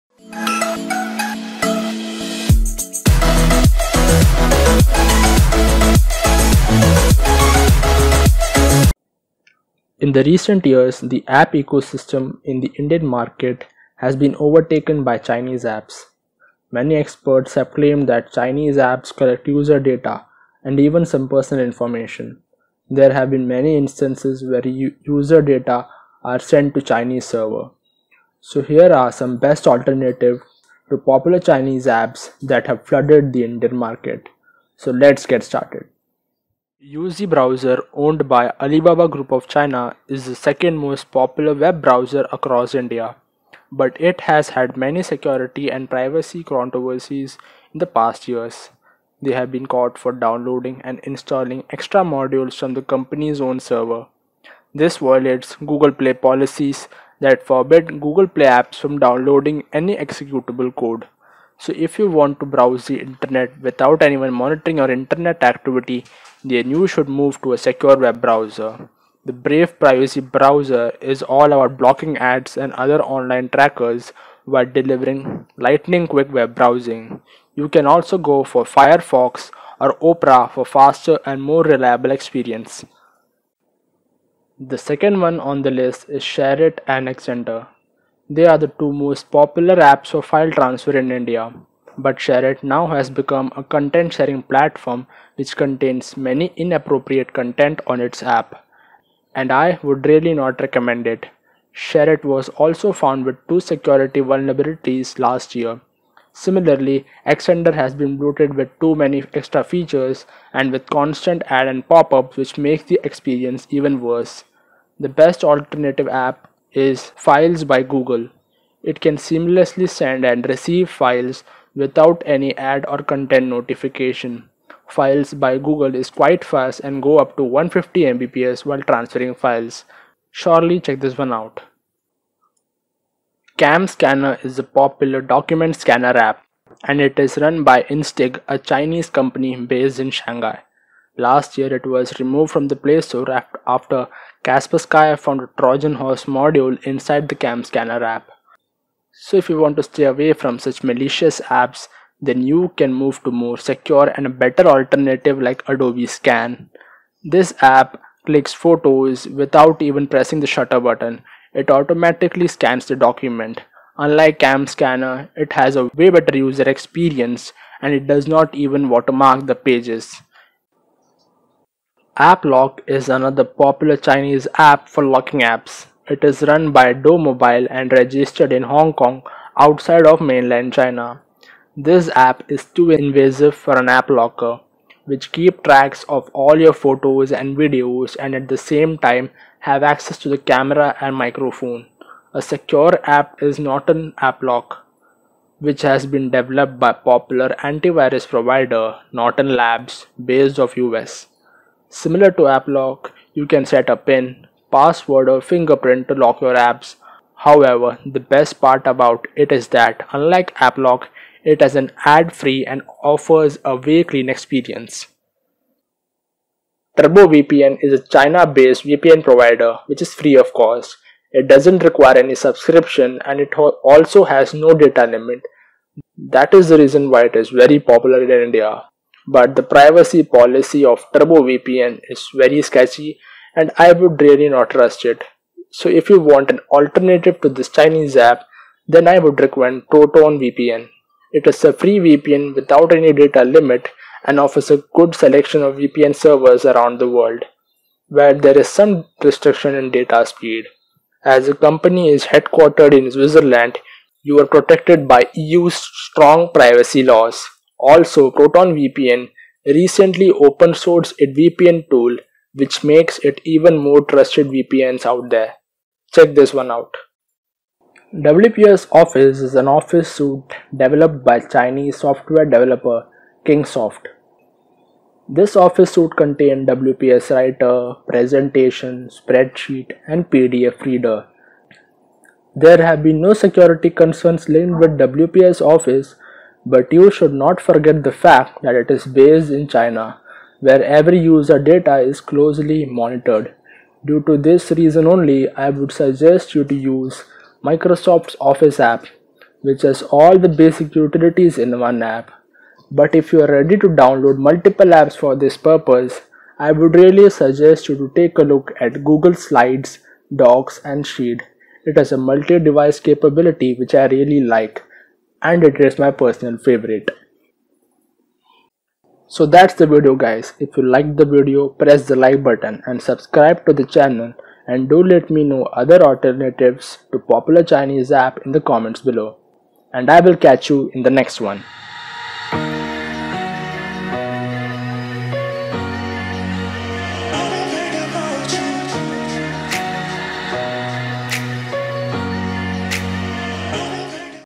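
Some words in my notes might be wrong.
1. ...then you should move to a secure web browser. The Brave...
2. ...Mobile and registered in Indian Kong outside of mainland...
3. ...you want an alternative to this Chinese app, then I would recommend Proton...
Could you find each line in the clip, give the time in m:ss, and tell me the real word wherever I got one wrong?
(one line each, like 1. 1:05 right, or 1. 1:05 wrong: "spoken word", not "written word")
1. 1:06 right
2. 2:57 wrong: "Hong", not "Indian"
3. 3:56 right.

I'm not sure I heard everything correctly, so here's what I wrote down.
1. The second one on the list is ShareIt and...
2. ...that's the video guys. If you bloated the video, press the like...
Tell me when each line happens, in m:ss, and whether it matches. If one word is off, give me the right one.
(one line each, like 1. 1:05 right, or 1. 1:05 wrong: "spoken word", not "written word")
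1. 1:24 right
2. 5:19 wrong: "liked", not "bloated".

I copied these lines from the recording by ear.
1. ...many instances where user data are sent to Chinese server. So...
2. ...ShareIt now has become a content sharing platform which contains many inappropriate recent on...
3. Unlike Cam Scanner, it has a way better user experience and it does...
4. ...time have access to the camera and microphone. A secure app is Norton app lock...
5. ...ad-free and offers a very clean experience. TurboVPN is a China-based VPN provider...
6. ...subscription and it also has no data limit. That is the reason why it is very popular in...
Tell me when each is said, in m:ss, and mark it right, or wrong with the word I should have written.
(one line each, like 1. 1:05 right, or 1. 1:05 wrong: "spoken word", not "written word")
1. 0:23 right
2. 1:32 wrong: "content", not "recent"
3. 2:43 right
4. 3:08 right
5. 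3:32 right
6. 3:42 right.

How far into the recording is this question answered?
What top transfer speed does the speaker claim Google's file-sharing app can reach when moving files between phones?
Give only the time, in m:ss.
2:07.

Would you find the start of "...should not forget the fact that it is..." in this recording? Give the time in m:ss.
4:47.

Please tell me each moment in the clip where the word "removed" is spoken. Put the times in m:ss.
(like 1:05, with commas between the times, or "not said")
2:22.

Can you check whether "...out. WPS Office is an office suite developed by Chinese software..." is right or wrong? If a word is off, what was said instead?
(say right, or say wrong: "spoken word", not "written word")
right.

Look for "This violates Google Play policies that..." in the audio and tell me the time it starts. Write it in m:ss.
0:54.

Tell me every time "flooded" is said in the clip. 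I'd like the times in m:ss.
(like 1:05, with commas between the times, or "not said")
0:32.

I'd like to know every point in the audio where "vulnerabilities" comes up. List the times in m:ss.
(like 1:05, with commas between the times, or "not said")
1:44.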